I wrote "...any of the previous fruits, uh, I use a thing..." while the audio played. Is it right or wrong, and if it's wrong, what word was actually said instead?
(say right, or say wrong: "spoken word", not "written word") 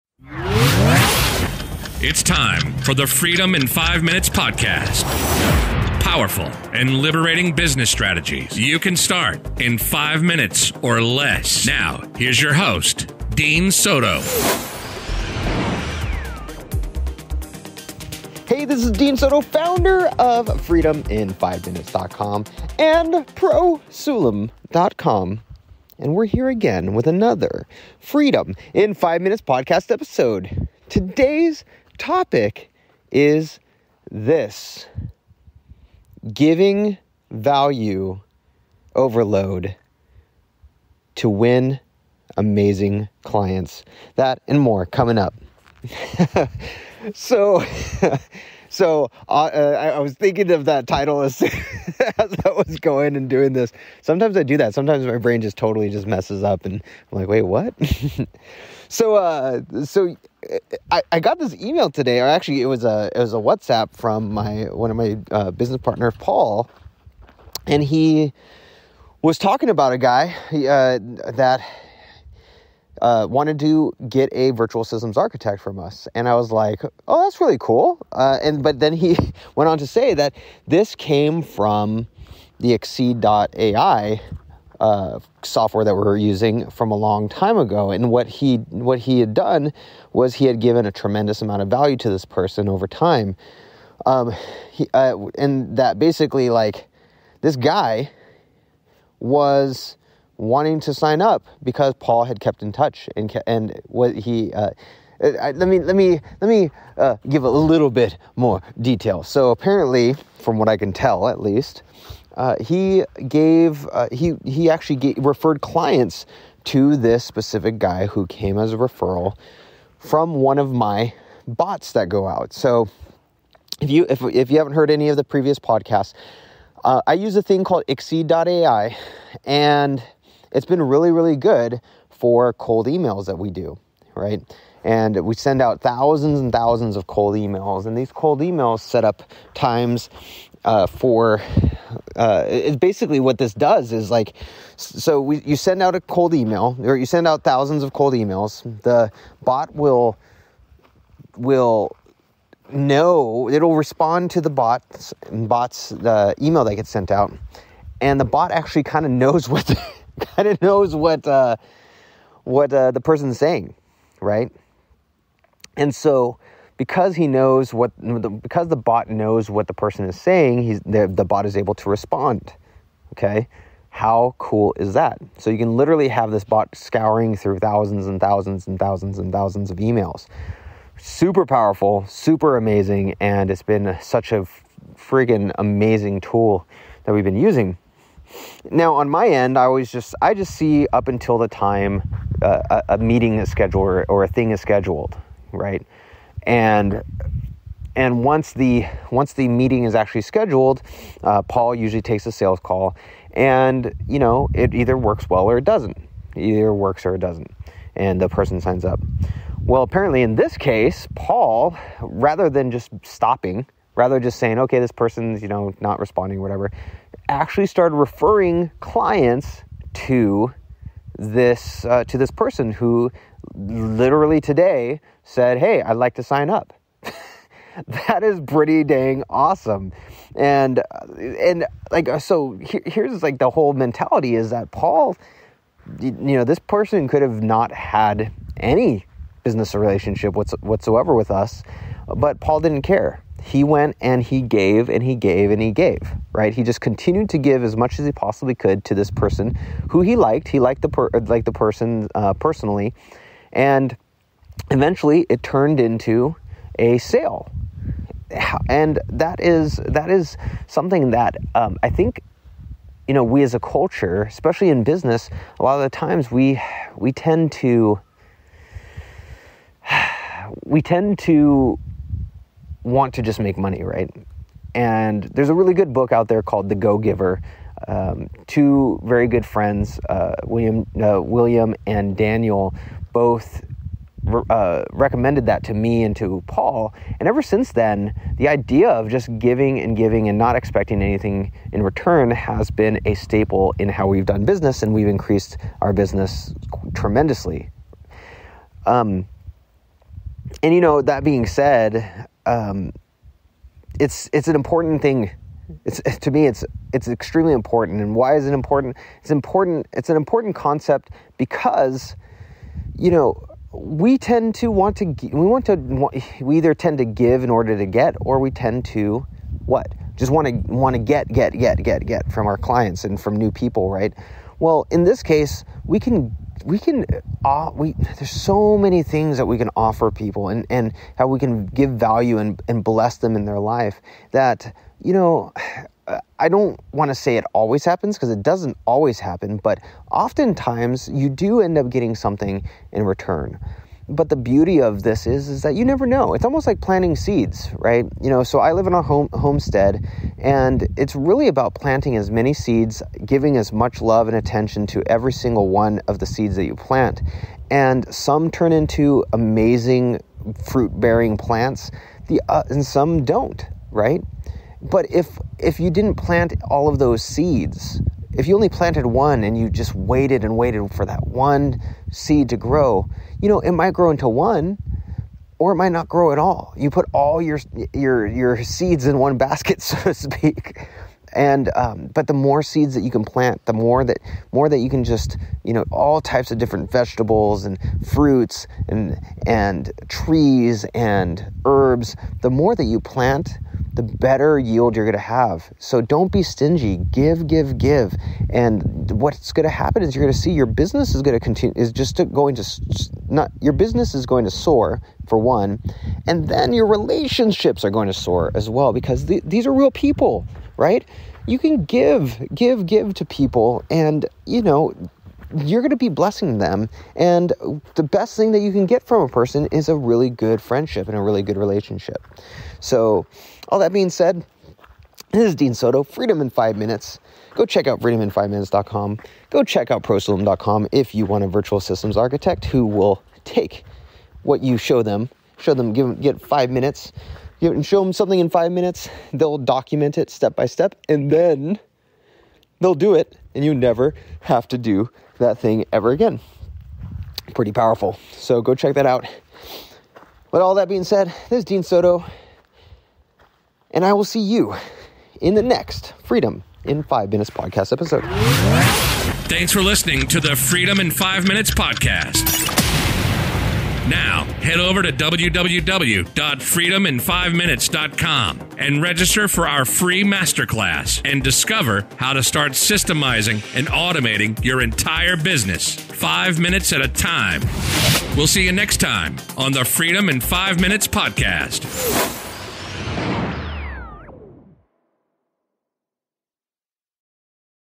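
wrong: "podcasts", not "fruits".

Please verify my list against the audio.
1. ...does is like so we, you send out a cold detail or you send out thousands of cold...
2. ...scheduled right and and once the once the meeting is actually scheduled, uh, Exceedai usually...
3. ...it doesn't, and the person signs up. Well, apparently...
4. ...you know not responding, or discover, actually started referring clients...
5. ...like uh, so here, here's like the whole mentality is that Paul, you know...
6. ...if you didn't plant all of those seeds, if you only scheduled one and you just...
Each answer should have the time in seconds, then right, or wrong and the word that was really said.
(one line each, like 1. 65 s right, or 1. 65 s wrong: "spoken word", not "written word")
1. 143 s wrong: "email", not "detail"
2. 194 s wrong: "Paul", not "Exceedai"
3. 207 s right
4. 215 s wrong: "whatever", not "discover"
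5. 231 s right
6. 365 s wrong: "planted", not "scheduled".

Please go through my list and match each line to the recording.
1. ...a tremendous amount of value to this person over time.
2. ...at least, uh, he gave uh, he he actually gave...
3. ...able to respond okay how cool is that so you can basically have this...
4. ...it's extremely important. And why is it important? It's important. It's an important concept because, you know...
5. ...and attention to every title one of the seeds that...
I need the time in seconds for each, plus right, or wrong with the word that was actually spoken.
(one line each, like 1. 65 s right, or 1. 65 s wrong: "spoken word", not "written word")
1. 90 s right
2. 111 s right
3. 171 s wrong: "literally", not "basically"
4. 306 s right
5. 354 s wrong: "single", not "title".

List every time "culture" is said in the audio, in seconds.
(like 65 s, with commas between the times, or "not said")
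263 s.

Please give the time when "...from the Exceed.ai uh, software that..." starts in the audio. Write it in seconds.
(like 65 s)
81 s.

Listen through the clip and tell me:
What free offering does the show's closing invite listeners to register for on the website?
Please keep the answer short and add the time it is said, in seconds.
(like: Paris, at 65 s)
masterclass, at 470 s.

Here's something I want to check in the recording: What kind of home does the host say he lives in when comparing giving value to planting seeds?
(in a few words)
homestead.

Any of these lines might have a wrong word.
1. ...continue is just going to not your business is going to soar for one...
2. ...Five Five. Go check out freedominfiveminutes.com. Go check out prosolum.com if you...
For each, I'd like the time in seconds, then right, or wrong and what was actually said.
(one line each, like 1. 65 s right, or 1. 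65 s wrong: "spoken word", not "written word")
1. 401 s right
2. 426 s wrong: "Minutes", not "Five".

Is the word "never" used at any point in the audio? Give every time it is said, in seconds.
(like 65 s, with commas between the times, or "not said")
345 s, 443 s.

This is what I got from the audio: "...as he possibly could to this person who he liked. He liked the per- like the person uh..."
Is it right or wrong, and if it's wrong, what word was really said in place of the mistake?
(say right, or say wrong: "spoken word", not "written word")
right.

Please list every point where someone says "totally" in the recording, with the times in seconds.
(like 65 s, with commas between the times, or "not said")
55 s.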